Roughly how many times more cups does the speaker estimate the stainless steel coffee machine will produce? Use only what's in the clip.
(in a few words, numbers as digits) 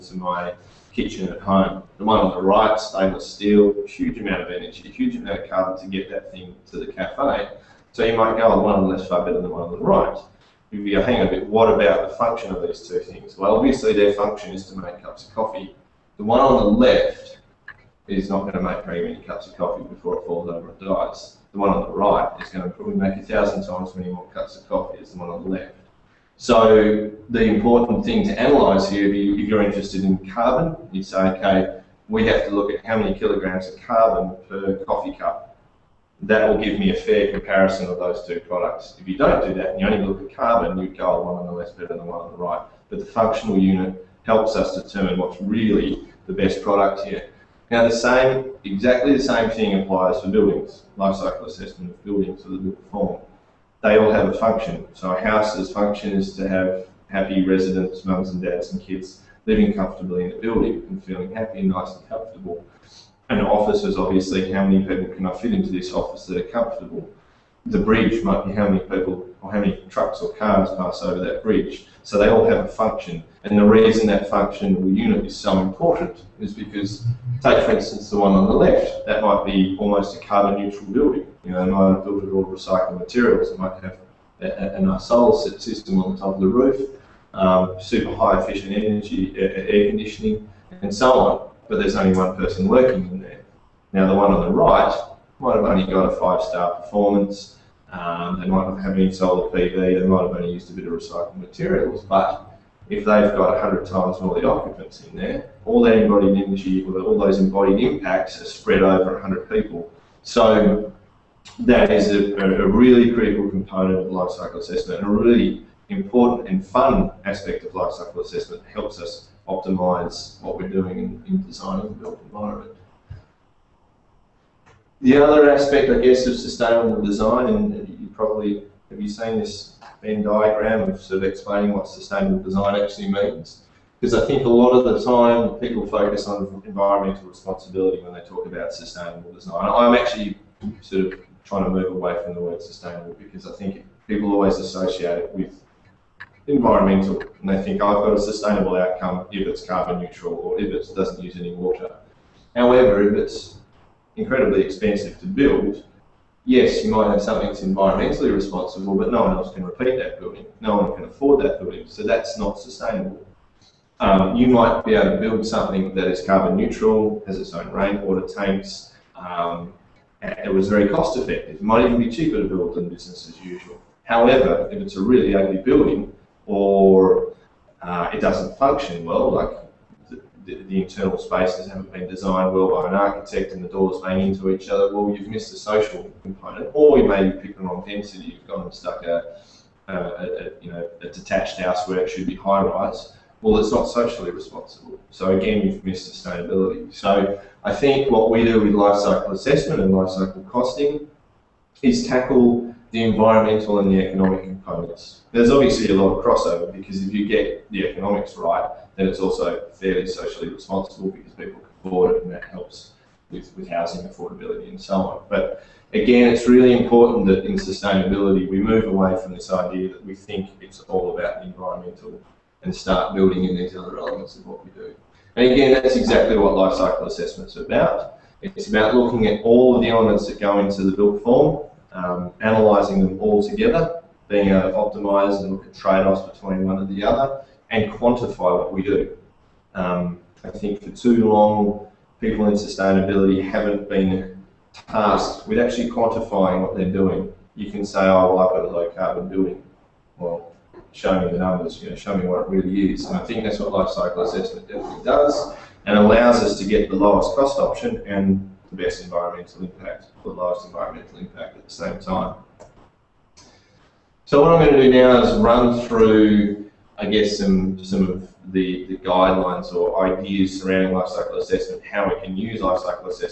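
1000.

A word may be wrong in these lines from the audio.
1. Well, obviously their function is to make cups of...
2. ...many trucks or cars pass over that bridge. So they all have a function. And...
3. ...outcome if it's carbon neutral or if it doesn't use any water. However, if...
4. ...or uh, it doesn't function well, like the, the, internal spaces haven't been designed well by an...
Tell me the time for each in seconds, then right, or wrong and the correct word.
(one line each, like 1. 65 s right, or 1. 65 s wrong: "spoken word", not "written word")
1. 13 s right
2. 69 s right
3. 148 s right
4. 176 s right.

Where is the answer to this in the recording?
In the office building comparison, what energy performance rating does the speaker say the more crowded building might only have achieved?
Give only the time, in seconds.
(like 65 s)
96 s.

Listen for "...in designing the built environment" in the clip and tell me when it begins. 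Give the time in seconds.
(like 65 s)
121 s.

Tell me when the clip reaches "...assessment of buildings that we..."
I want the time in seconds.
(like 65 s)
51 s.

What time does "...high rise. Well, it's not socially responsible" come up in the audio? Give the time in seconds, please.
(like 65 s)
192 s.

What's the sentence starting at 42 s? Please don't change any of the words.
But the functional unit helps us determine what's really the best product here.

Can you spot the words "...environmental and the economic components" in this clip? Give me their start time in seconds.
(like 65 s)
203 s.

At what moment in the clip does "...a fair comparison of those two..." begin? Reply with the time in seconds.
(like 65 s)
36 s.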